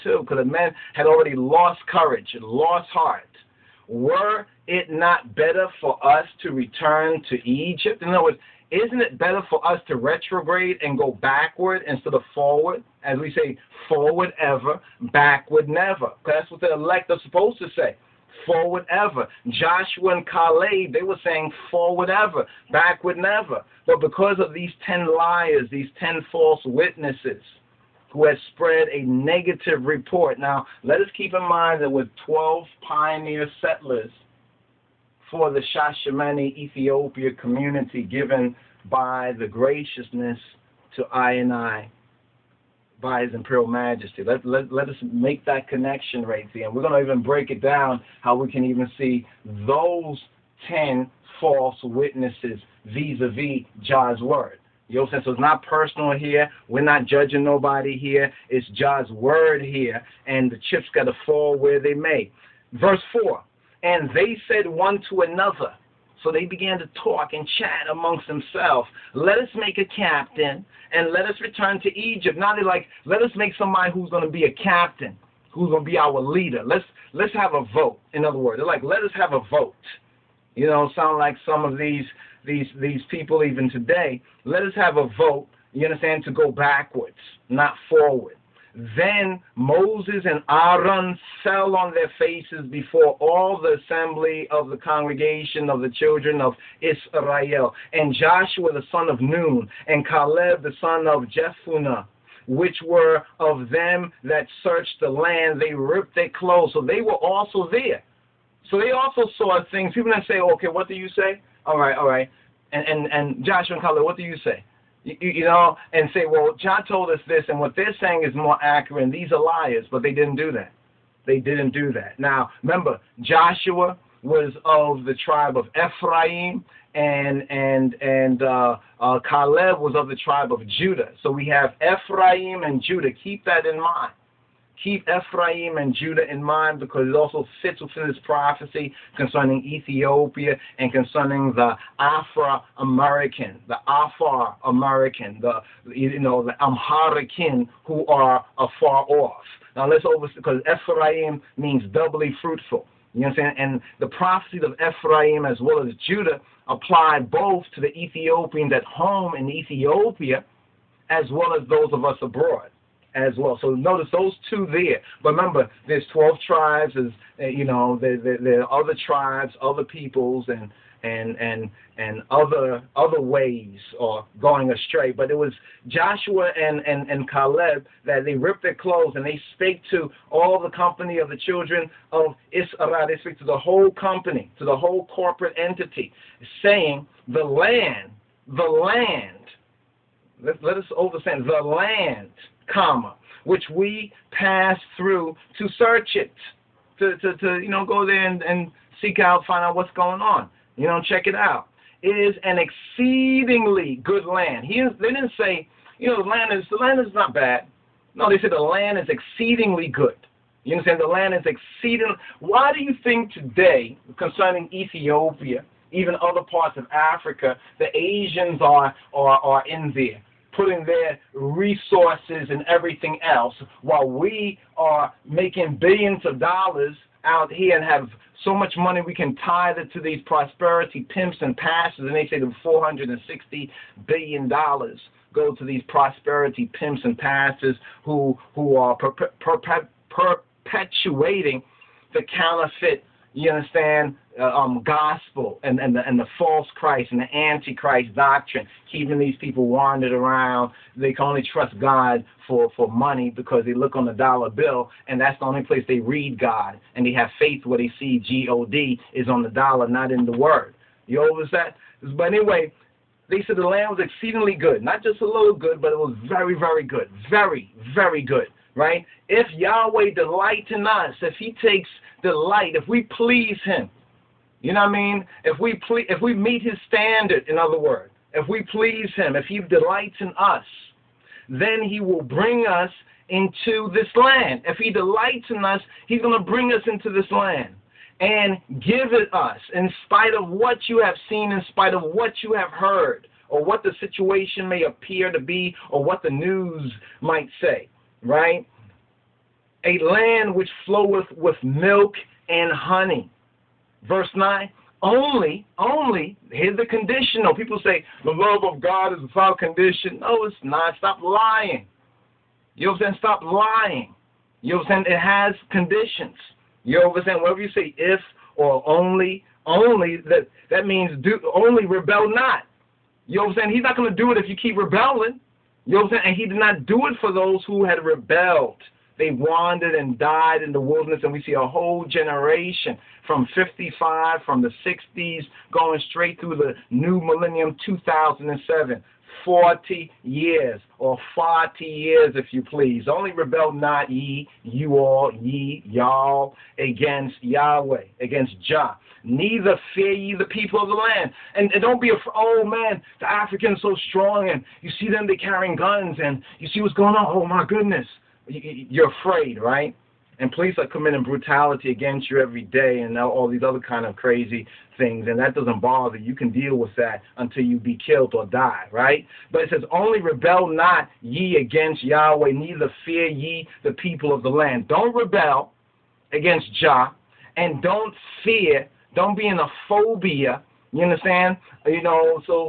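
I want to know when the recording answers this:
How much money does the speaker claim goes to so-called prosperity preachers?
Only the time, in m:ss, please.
3:52.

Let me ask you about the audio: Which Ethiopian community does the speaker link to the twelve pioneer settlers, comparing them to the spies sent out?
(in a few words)
Shashamane.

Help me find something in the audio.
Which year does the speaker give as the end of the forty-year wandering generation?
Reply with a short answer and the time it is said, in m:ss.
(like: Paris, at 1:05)
2007, at 5:37.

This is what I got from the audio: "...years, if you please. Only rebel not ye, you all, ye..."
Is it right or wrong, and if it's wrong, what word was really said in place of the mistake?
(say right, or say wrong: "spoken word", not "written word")
right.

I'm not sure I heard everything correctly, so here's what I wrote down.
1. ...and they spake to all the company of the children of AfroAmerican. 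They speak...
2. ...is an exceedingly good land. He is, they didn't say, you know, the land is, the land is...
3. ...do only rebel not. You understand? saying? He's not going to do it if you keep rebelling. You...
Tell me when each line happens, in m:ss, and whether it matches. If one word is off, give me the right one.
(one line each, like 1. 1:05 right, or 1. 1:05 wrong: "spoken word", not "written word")
1. 2:59 wrong: "Israel", not "AfroAmerican"
2. 3:22 right
3. 5:21 right.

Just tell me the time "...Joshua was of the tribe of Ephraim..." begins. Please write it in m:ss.
2:03.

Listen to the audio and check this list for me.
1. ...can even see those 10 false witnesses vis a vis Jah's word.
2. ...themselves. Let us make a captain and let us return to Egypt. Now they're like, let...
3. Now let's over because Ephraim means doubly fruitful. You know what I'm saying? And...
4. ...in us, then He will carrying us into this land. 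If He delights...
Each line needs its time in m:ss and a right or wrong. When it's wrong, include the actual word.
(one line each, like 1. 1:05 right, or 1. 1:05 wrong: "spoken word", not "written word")
1. 0:48 right
2. 1:08 right
3. 2:29 right
4. 4:40 wrong: "bring", not "carrying".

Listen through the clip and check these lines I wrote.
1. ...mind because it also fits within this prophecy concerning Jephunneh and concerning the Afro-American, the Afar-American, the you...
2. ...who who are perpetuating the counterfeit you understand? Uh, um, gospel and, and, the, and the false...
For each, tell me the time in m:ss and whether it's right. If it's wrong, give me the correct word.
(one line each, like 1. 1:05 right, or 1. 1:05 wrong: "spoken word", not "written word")
1. 2:16 wrong: "Ethiopia", not "Jephunneh"
2. 3:58 right.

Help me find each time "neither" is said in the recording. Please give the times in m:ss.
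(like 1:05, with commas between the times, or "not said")
5:49, 6:12.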